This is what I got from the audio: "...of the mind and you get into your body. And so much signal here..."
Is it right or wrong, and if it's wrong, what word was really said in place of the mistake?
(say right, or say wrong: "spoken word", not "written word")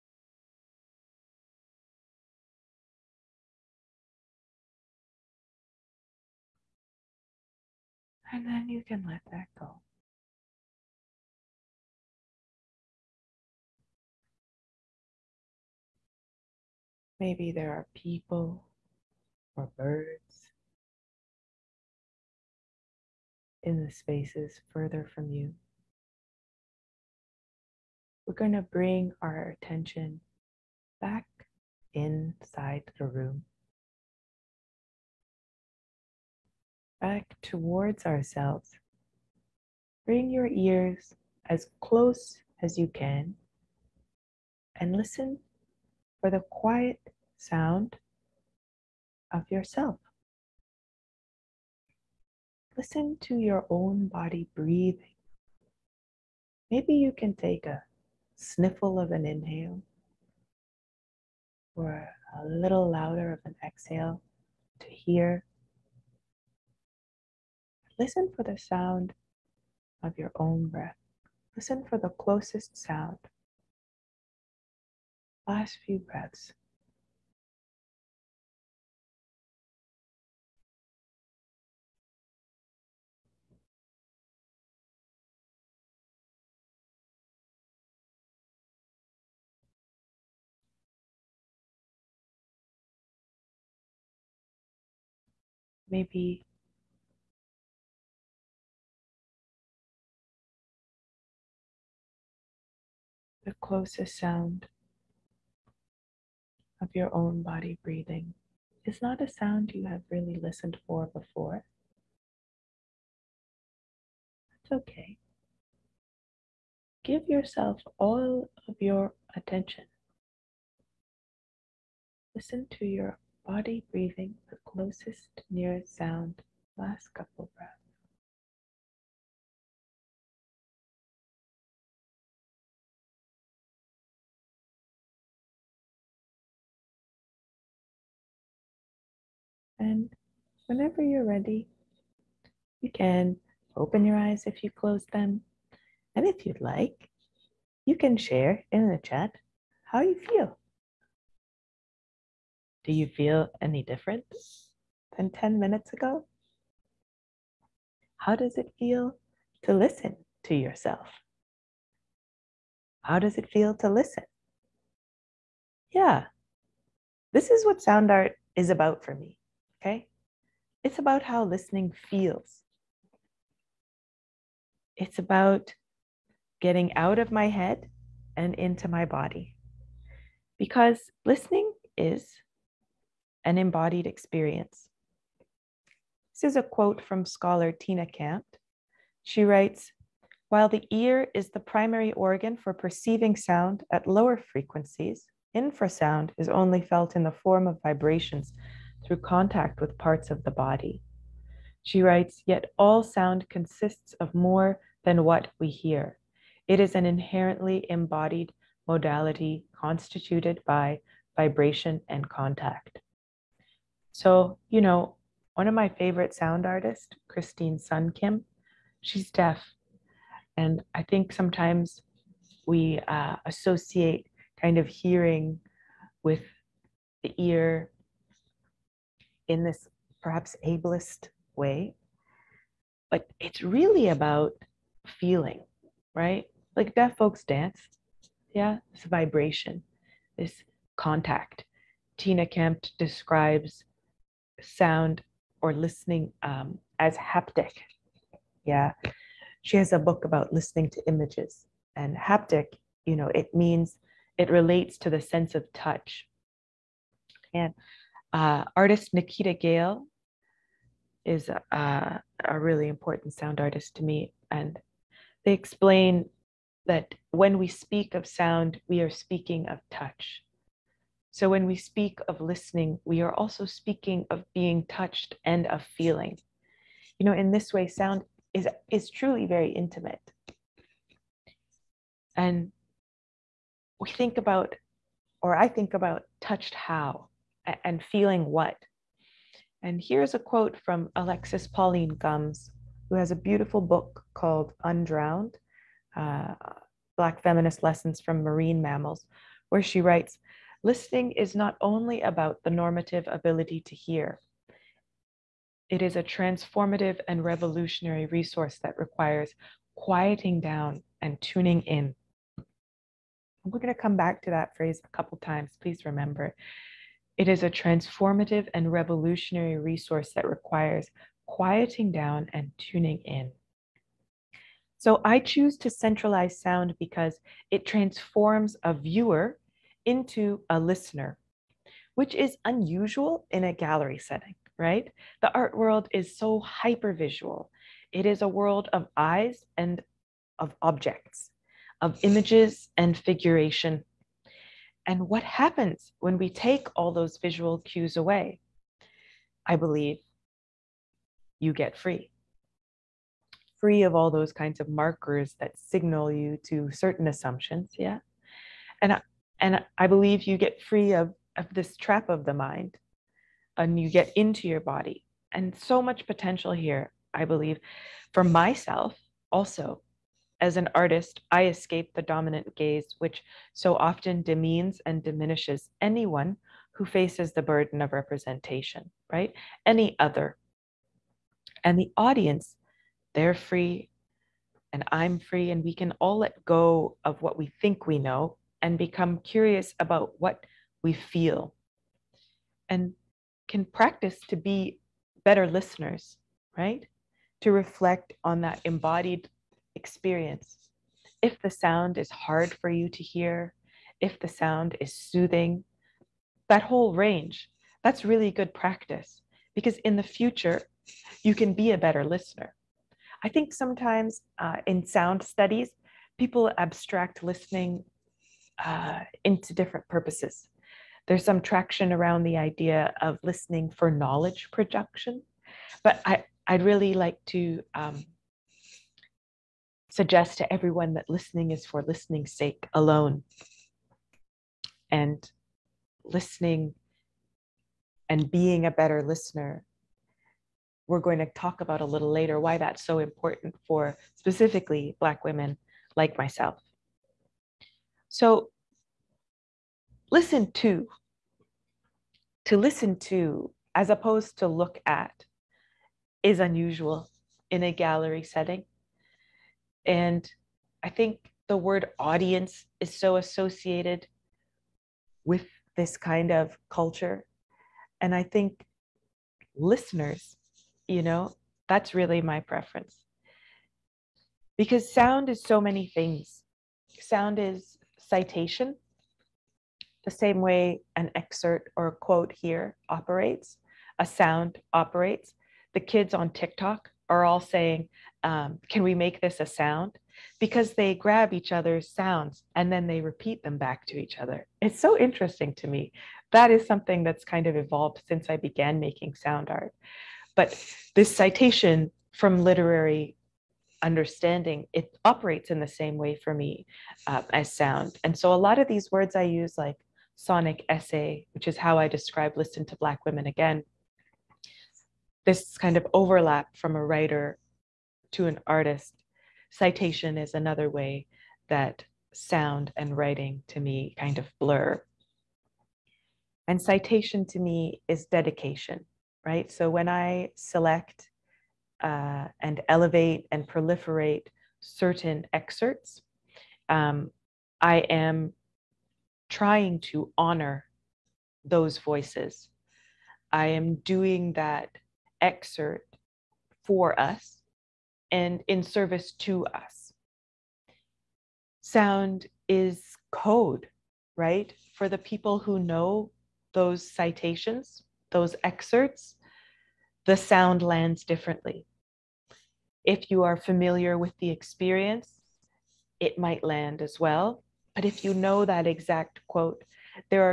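wrong: "potential", not "signal".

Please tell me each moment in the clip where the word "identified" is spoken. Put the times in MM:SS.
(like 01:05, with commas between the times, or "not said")
not said.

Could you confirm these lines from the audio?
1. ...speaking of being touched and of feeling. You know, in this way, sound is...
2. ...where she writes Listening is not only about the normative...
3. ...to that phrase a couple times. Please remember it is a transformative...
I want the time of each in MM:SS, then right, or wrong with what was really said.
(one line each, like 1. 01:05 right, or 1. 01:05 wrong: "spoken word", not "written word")
1. 04:33 right
2. 04:59 right
3. 05:14 right.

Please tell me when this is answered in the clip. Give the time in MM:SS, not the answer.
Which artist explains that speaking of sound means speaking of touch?
04:19.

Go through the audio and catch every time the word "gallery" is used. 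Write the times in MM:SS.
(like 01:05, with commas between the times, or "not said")
05:33, 07:37.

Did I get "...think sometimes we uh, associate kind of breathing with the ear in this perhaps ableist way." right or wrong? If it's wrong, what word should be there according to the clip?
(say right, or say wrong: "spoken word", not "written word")
wrong: "hearing", not "breathing".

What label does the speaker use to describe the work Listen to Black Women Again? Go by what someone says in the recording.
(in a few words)
sonic essay.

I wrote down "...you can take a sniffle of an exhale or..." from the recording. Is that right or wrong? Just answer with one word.
wrong.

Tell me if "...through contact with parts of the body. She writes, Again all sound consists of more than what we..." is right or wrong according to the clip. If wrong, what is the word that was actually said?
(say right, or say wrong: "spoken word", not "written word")
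wrong: "Yet", not "Again".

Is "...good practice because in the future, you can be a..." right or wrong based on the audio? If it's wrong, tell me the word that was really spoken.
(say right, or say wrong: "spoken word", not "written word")
right.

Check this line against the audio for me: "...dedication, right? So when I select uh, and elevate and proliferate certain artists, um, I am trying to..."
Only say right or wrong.
wrong.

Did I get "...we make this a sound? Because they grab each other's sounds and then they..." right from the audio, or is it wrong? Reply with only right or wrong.
right.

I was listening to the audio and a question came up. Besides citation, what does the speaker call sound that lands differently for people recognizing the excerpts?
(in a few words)
code.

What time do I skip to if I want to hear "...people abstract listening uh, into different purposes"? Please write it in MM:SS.
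06:56.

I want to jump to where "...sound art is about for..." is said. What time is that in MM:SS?
02:47.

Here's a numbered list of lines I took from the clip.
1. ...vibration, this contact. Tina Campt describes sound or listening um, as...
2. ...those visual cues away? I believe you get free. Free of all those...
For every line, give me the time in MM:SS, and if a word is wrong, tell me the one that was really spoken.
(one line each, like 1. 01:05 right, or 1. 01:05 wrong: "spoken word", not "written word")
1. 03:59 right
2. 05:47 right.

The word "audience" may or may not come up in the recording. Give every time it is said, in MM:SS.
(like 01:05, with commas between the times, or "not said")
06:22, 07:42.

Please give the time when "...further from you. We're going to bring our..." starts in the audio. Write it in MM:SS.
00:24.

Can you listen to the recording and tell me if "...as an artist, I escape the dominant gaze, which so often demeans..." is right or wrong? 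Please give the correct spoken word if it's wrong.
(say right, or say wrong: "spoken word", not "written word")
right.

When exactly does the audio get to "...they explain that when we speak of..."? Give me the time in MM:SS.
04:25.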